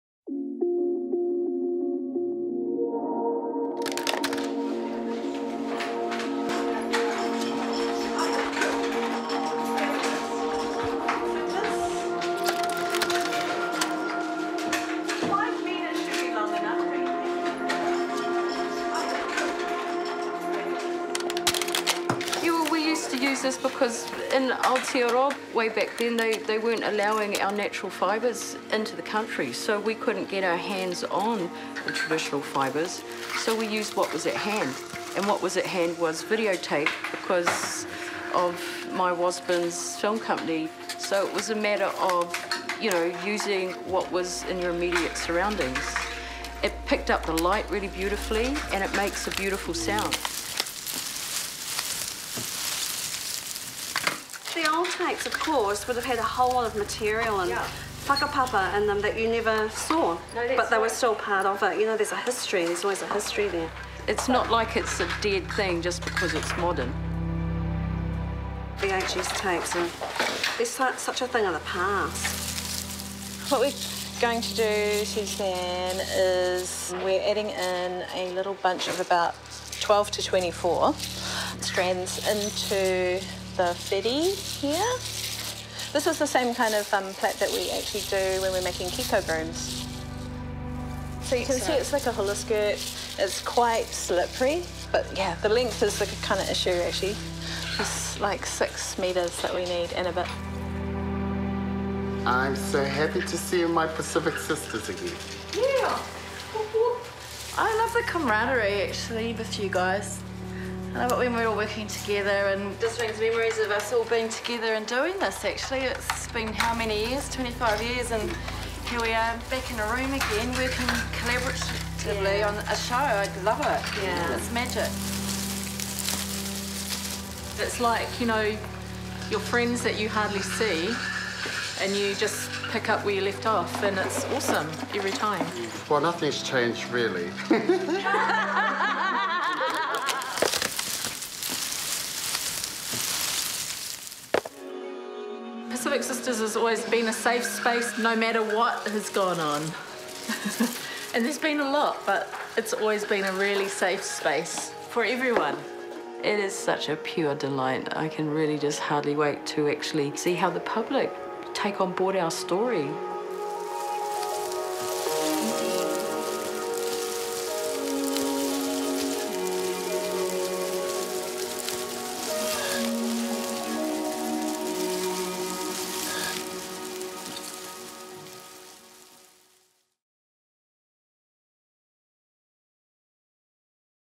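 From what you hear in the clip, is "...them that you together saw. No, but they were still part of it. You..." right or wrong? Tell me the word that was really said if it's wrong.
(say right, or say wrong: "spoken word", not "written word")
wrong: "never", not "together".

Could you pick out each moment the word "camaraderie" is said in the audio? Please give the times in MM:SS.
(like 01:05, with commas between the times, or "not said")
01:48.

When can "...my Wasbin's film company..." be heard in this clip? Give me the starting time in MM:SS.
00:38.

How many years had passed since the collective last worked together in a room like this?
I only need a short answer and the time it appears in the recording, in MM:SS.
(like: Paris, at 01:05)
25 years, at 01:57.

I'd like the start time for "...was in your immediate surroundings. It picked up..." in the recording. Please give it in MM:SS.
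00:44.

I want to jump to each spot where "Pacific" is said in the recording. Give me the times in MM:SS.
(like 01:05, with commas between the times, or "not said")
01:43, 02:25.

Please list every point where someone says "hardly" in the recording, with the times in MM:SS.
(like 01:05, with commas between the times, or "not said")
02:10, 02:38.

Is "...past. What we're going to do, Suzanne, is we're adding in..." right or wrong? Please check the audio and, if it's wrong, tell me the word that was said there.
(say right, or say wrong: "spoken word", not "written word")
right.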